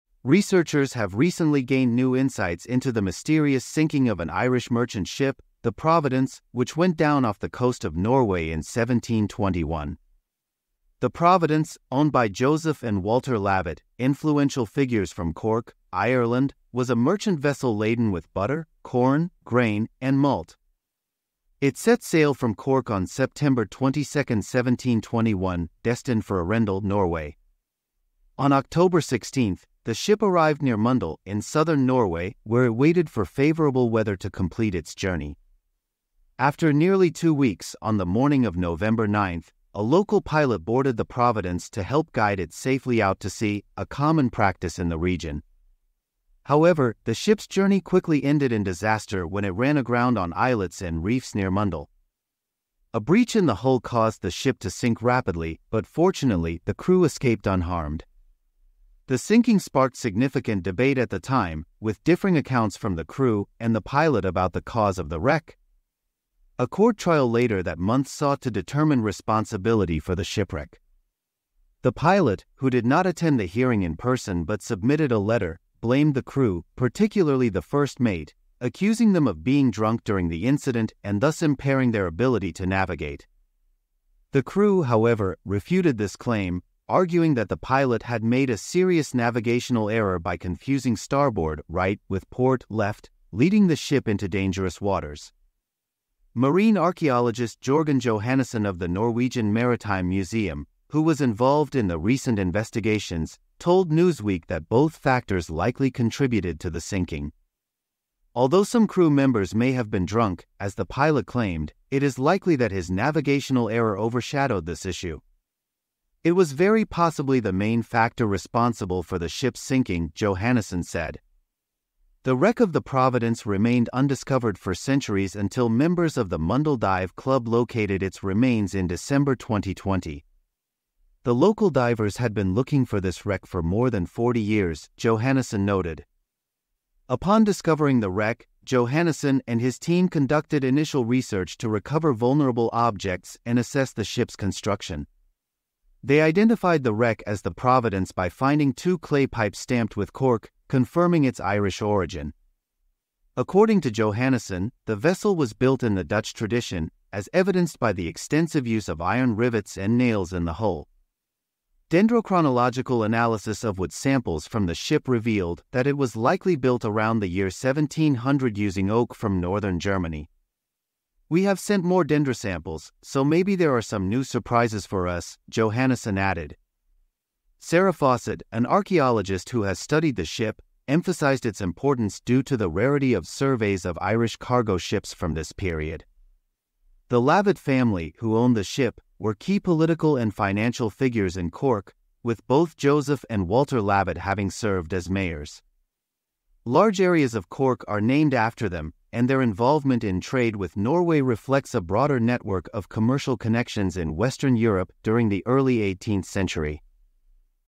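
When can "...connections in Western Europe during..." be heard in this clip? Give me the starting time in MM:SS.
03:23.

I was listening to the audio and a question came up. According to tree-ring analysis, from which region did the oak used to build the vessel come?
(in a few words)
Northern Germany.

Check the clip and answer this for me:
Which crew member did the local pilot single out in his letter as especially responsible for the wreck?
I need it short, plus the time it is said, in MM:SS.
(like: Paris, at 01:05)
The first mate, at 01:17.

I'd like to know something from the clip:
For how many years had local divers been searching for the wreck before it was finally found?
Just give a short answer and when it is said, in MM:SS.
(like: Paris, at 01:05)
More than 40, at 02:13.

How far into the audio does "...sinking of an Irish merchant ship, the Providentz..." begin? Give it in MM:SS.
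00:03.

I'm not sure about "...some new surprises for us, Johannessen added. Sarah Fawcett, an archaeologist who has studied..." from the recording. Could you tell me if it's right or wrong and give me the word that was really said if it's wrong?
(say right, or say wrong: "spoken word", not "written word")
right.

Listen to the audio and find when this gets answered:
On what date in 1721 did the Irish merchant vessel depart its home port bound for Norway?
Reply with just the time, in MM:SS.
00:23.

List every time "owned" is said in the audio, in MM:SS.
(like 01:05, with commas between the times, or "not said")
00:11, 03:08.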